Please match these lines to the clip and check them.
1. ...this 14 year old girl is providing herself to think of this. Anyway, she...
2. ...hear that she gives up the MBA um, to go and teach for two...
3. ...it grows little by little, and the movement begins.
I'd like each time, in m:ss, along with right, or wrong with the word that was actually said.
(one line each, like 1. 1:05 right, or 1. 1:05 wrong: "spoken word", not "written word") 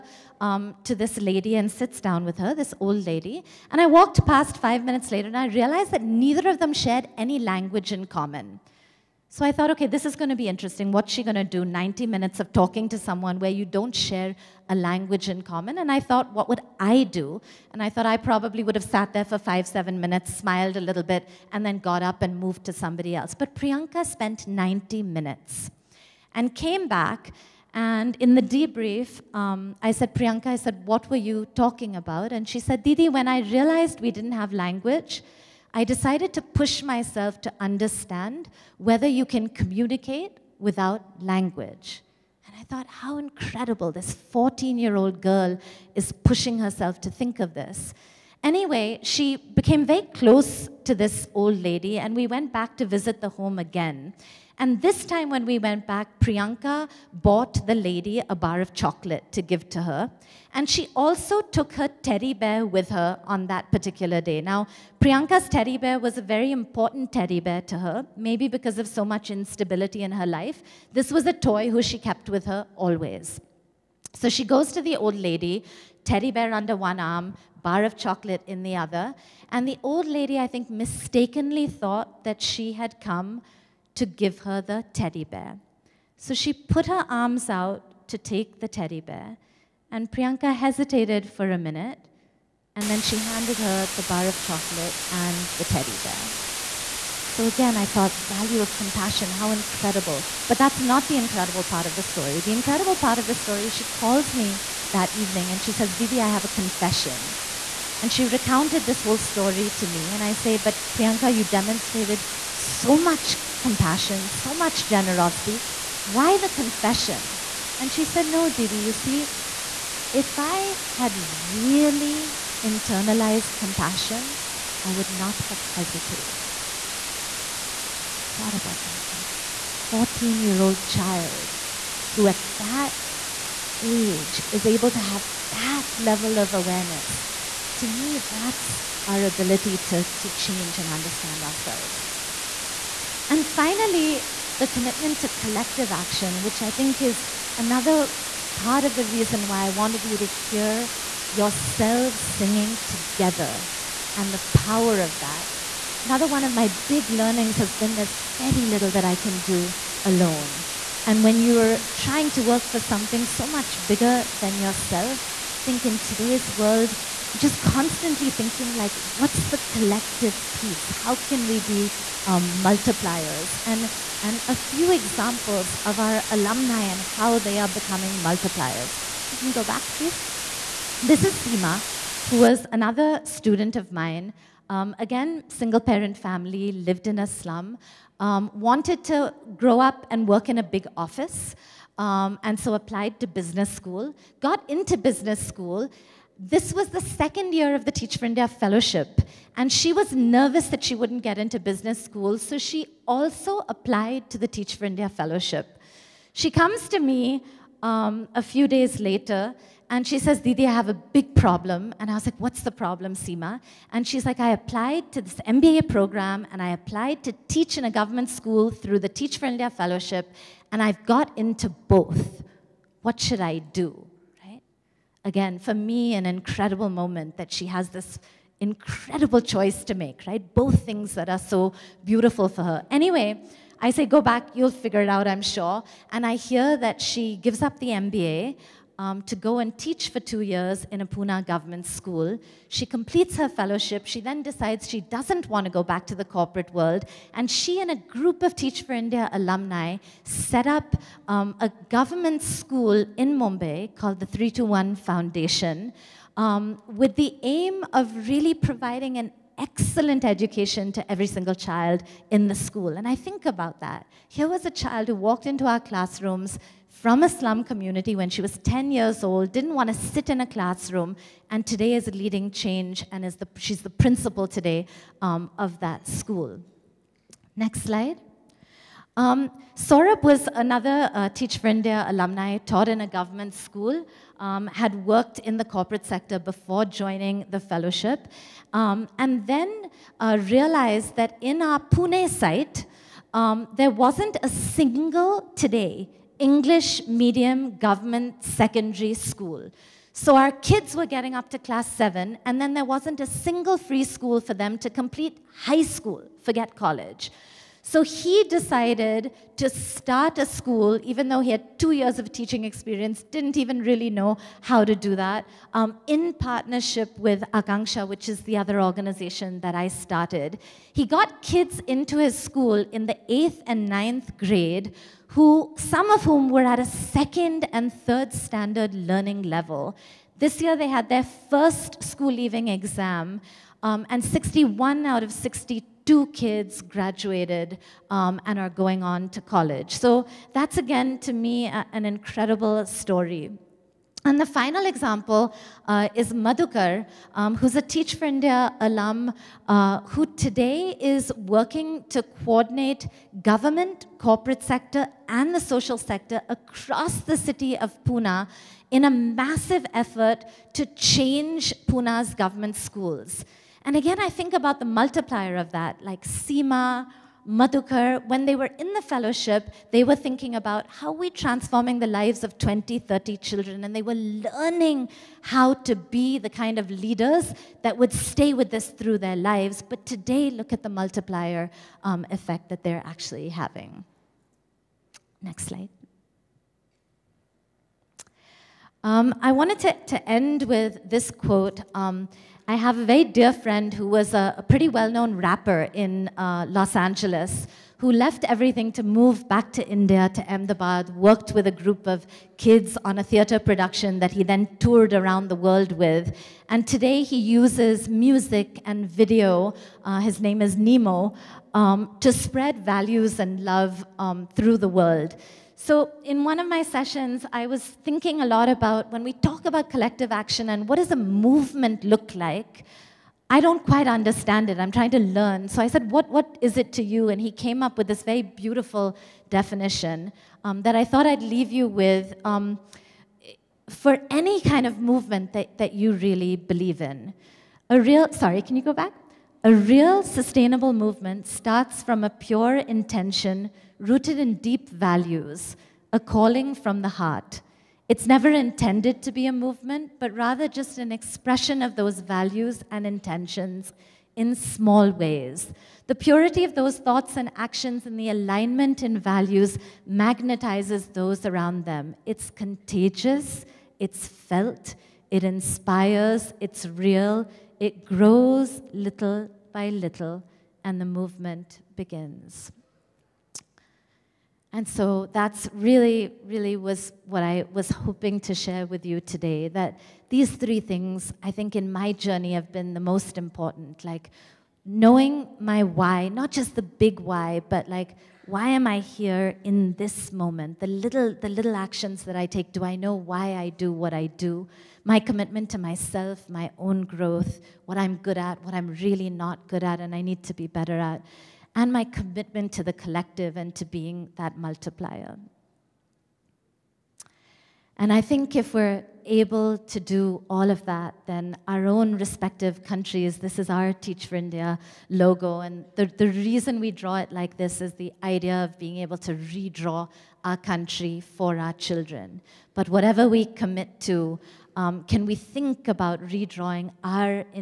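1. 0:43 wrong: "pushing", not "providing"
2. 3:56 right
3. 7:47 right.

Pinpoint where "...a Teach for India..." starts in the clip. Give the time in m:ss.
5:47.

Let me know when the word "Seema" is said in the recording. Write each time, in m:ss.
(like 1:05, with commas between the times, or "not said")
3:01, 3:33, 6:06.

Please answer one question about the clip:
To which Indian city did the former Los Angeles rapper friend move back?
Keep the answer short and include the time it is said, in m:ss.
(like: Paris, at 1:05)
Ahmedabad, at 6:40.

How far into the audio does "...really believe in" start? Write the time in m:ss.
7:16.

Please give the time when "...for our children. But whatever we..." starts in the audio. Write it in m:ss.
8:41.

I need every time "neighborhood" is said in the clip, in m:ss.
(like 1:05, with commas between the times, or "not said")
not said.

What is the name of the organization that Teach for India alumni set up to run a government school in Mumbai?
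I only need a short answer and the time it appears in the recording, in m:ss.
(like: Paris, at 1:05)
321 Foundation, at 4:14.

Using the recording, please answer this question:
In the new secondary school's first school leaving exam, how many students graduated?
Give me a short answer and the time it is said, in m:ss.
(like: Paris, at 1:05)
61, at 5:34.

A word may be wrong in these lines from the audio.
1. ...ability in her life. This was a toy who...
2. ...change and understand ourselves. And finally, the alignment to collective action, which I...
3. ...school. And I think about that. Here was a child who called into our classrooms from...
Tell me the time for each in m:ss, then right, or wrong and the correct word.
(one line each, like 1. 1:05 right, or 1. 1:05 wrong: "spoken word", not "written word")
1. 1:09 wrong: "instability", not "ability"
2. 2:20 wrong: "commitment", not "alignment"
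3. 4:22 wrong: "walked", not "called".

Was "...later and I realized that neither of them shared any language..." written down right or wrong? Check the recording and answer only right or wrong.
right.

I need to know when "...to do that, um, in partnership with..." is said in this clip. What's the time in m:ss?
5:14.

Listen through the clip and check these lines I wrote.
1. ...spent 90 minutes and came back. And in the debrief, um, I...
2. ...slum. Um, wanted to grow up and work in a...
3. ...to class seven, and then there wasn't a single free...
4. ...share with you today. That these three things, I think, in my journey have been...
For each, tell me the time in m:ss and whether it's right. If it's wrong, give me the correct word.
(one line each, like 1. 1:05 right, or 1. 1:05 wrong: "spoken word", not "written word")
1. 0:24 right
2. 3:07 right
3. 5:01 right
4. 7:58 right.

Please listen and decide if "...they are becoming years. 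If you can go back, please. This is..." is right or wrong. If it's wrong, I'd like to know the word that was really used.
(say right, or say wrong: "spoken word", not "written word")
wrong: "multipliers", not "years".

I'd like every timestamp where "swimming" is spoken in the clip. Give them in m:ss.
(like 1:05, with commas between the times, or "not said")
not said.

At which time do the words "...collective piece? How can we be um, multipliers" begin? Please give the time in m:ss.
2:49.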